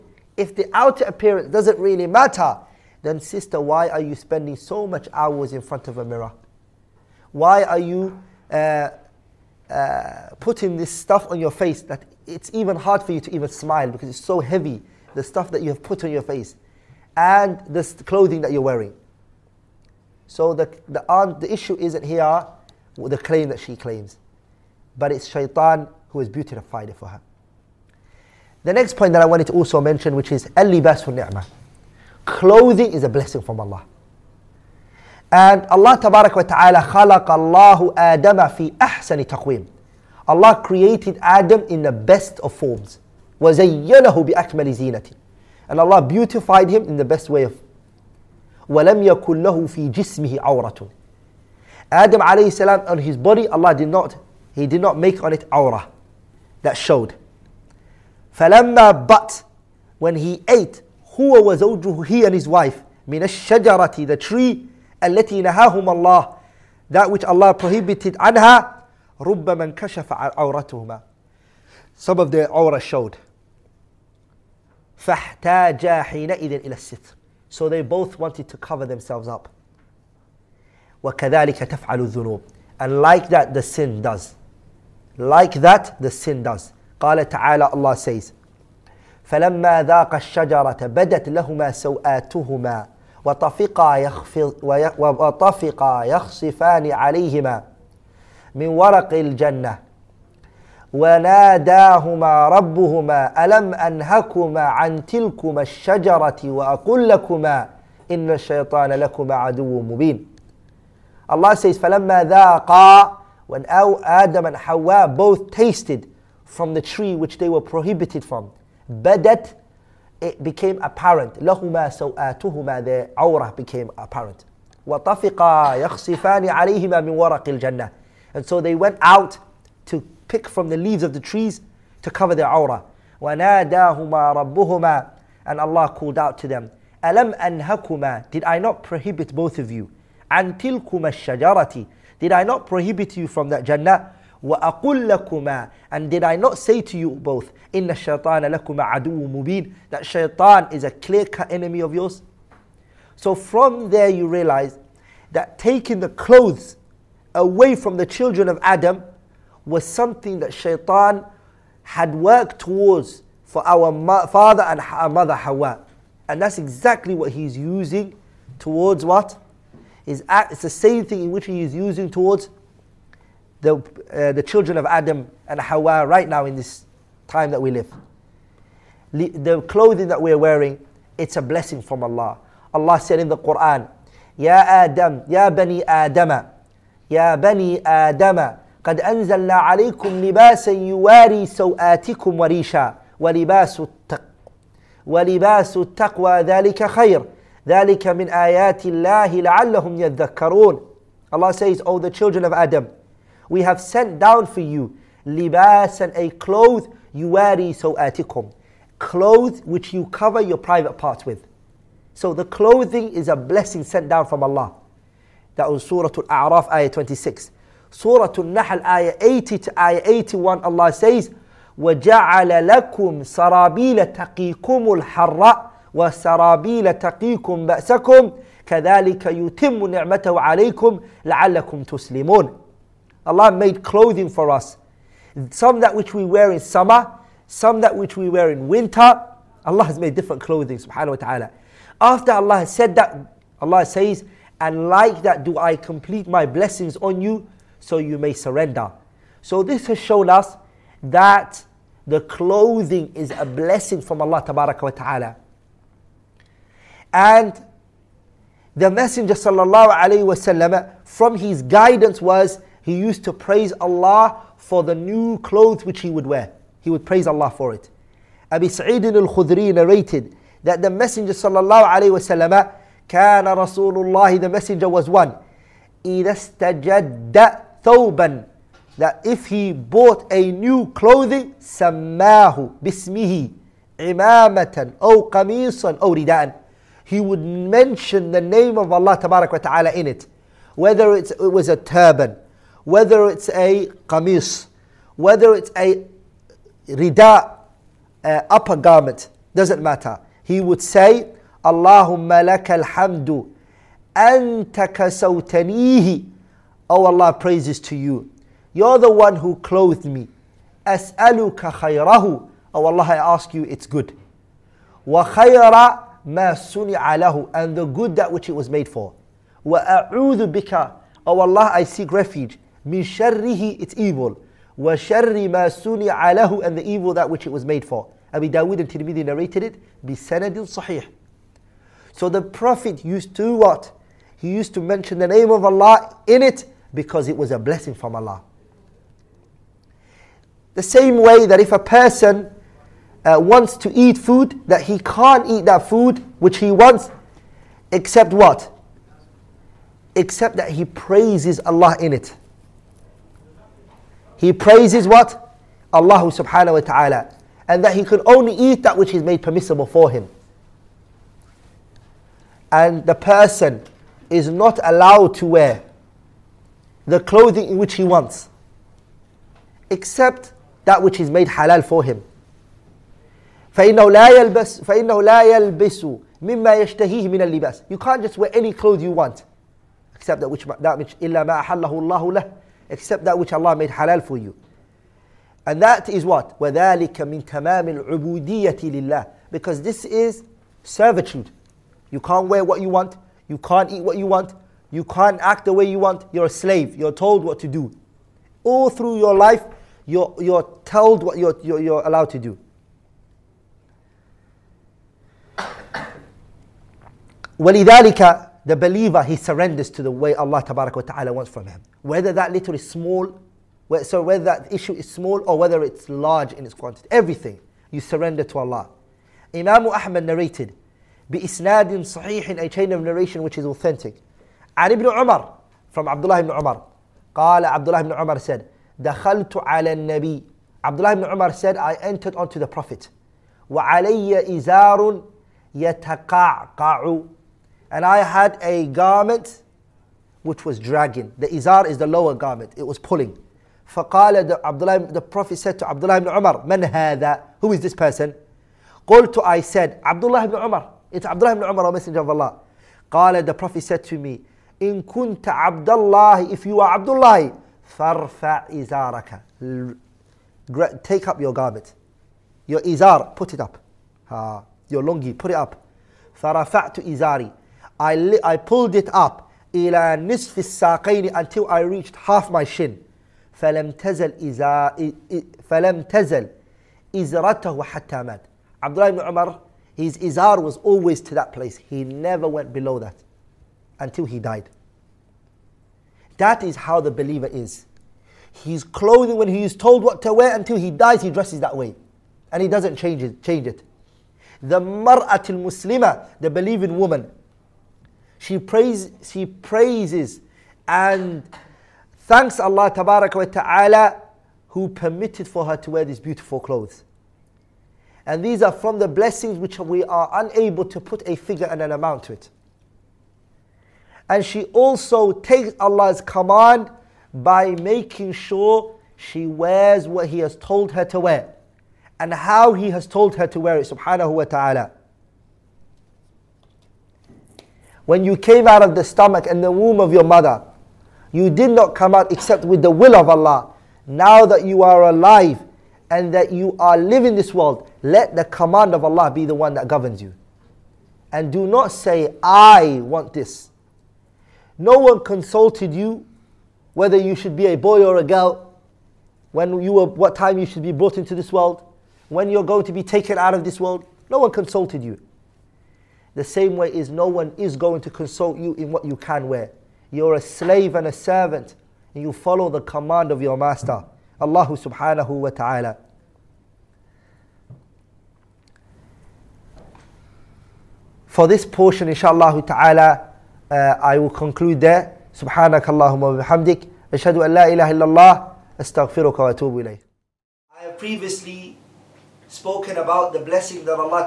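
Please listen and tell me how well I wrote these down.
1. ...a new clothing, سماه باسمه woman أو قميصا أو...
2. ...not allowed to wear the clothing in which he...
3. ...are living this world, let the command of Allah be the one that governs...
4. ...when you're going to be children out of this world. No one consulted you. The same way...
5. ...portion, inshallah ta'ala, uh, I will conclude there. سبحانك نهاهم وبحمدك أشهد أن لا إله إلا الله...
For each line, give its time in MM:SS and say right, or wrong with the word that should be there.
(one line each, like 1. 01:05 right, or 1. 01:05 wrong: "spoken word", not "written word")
1. 04:40 wrong: "imamatan", not "woman"
2. 06:04 right
3. 08:56 right
4. 09:12 wrong: "taken", not "children"
5. 09:31 wrong: "اللهم", not "نهاهم".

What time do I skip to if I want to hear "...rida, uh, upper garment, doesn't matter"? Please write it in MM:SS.
04:56.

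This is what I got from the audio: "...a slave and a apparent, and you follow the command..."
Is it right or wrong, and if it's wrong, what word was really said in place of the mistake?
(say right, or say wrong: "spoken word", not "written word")
wrong: "servant", not "apparent".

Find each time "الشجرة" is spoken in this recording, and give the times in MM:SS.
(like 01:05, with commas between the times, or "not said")
01:03, 01:30, 01:45, 02:21.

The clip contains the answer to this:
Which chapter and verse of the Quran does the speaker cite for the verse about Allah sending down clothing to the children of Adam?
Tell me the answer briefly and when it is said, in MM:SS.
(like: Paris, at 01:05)
Surah Al-A'raf, ayah 26, at 03:35.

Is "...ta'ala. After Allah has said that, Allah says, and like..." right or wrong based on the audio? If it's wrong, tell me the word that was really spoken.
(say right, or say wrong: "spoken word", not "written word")
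right.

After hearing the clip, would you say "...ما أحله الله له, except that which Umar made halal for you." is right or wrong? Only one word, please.
wrong.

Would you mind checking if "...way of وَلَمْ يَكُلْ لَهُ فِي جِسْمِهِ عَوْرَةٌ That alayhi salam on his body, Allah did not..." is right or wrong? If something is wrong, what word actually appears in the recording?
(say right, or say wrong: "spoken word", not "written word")
wrong: "Adam", not "That".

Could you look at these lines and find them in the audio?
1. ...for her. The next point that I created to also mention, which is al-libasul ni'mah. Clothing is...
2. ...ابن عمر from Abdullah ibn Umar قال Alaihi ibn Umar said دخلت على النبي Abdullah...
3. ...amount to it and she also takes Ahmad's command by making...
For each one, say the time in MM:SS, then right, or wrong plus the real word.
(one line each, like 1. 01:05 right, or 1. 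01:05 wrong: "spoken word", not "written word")
1. 00:26 wrong: "wanted", not "created"
2. 07:04 wrong: "Abdullah", not "Alaihi"
3. 08:31 wrong: "Allah", not "Ahmad".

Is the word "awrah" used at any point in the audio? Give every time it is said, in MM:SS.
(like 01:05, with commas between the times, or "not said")
00:55, 01:12, 02:12.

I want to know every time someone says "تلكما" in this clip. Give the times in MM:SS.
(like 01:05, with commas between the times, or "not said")
01:45, 02:20.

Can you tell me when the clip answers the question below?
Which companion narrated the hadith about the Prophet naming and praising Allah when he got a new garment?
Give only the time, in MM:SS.
04:28.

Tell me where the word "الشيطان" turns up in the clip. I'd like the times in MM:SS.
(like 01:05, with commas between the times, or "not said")
01:48, 02:27.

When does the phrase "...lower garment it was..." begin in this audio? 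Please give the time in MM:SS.
07:22.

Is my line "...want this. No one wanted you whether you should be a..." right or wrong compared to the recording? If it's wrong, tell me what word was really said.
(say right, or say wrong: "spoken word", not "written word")
wrong: "consulted", not "wanted".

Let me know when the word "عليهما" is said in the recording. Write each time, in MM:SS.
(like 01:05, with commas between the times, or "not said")
01:36, 02:06.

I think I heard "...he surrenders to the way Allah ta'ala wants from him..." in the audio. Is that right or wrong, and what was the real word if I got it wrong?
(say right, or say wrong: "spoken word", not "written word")
right.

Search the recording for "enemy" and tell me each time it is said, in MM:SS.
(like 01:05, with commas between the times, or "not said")
02:31.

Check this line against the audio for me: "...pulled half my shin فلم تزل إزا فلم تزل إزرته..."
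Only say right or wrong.
wrong.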